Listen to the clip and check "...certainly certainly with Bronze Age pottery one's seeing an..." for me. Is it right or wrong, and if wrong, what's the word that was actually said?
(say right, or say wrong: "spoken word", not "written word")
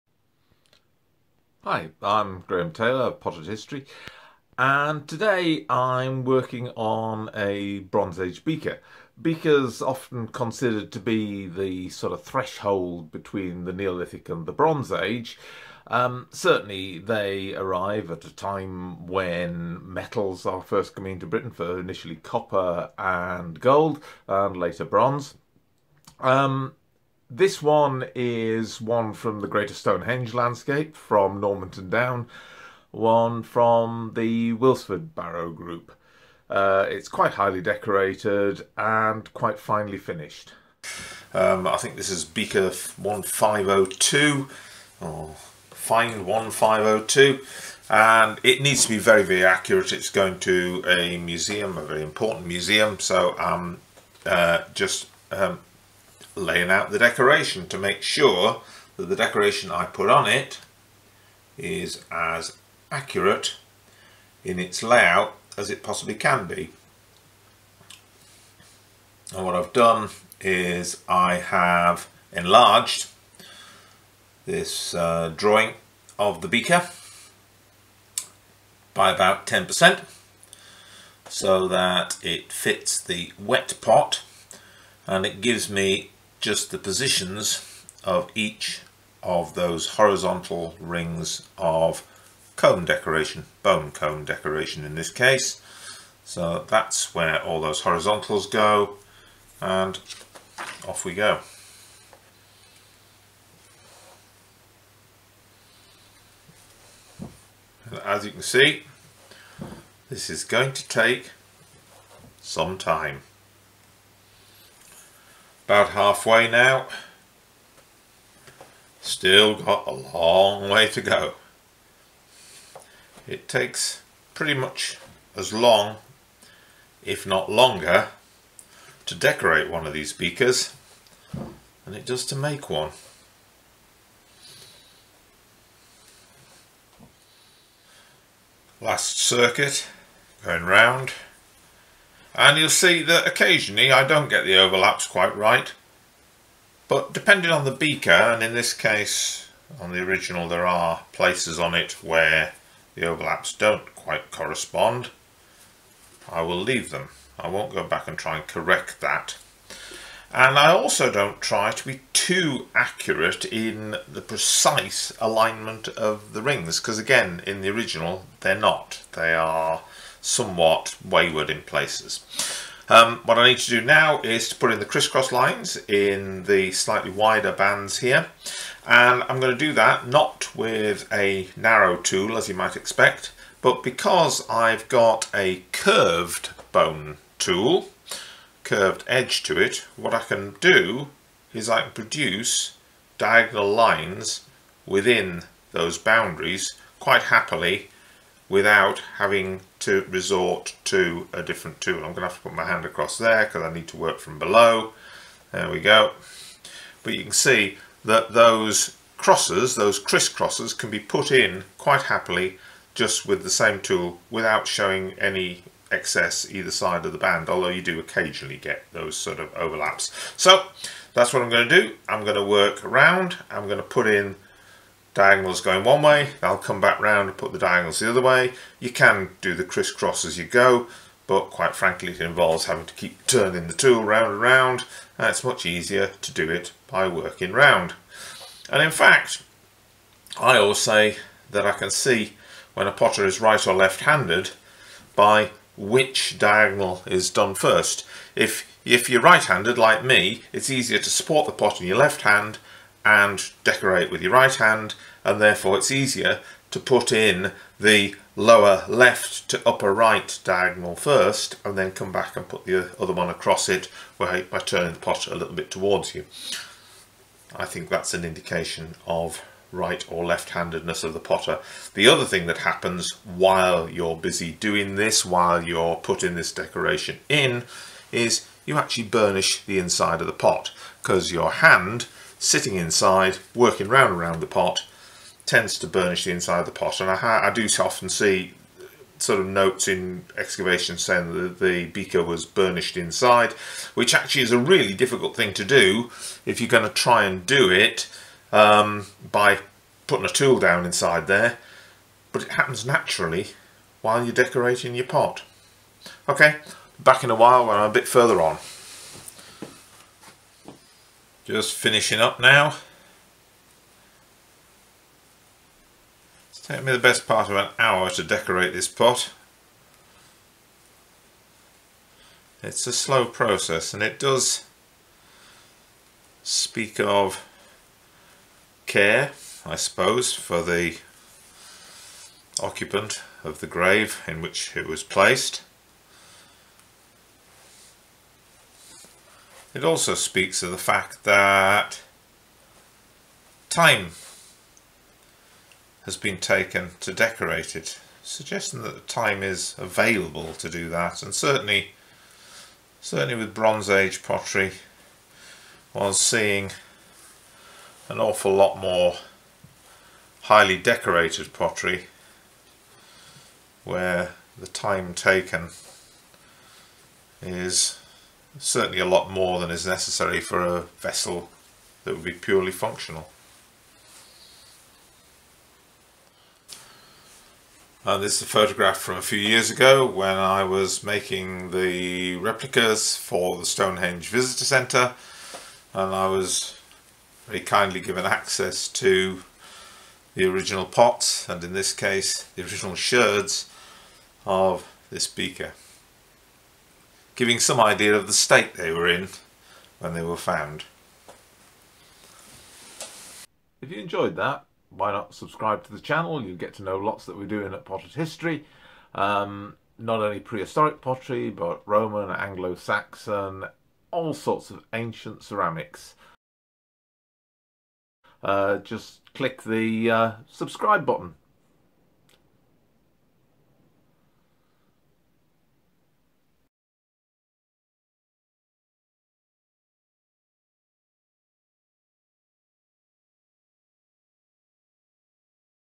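right.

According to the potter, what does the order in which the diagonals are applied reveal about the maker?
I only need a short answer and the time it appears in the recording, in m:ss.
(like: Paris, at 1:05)
right or left-handedness, at 4:03.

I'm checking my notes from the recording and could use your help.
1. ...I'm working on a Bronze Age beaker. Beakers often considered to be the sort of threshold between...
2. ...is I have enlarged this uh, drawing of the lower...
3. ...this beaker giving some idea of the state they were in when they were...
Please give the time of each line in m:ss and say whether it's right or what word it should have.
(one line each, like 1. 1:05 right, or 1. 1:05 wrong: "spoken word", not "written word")
1. 0:05 right
2. 1:10 wrong: "beaker", not "lower"
3. 6:35 right.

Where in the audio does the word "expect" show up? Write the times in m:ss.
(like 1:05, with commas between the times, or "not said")
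3:02.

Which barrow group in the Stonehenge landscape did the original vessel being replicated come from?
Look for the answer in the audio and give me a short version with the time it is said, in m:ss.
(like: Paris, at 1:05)
Wilsford Barrow Group, at 0:34.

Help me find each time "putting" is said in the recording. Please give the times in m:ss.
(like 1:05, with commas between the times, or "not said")
4:35, 5:00.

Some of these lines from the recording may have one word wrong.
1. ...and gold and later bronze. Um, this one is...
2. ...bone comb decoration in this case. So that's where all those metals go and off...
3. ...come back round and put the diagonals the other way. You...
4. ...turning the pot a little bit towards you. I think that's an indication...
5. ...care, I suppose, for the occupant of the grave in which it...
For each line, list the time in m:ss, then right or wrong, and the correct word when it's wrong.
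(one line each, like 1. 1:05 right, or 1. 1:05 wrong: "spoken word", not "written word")
1. 0:22 right
2. 1:33 wrong: "horizontals", not "metals"
3. 3:46 right
4. 4:24 right
5. 5:28 right.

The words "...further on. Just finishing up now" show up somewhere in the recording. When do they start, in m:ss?
5:08.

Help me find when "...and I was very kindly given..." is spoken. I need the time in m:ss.
6:25.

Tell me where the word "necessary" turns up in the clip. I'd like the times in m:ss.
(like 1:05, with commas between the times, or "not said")
6:09.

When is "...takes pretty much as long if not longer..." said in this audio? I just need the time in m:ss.
2:03.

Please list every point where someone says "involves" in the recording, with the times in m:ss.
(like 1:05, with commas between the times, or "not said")
3:52.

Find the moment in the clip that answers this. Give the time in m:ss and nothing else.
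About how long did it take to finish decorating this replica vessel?
5:16.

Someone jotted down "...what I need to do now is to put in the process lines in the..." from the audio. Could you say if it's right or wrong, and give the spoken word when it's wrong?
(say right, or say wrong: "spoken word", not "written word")
wrong: "crisscross", not "process".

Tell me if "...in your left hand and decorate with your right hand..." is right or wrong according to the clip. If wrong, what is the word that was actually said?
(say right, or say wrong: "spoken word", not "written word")
right.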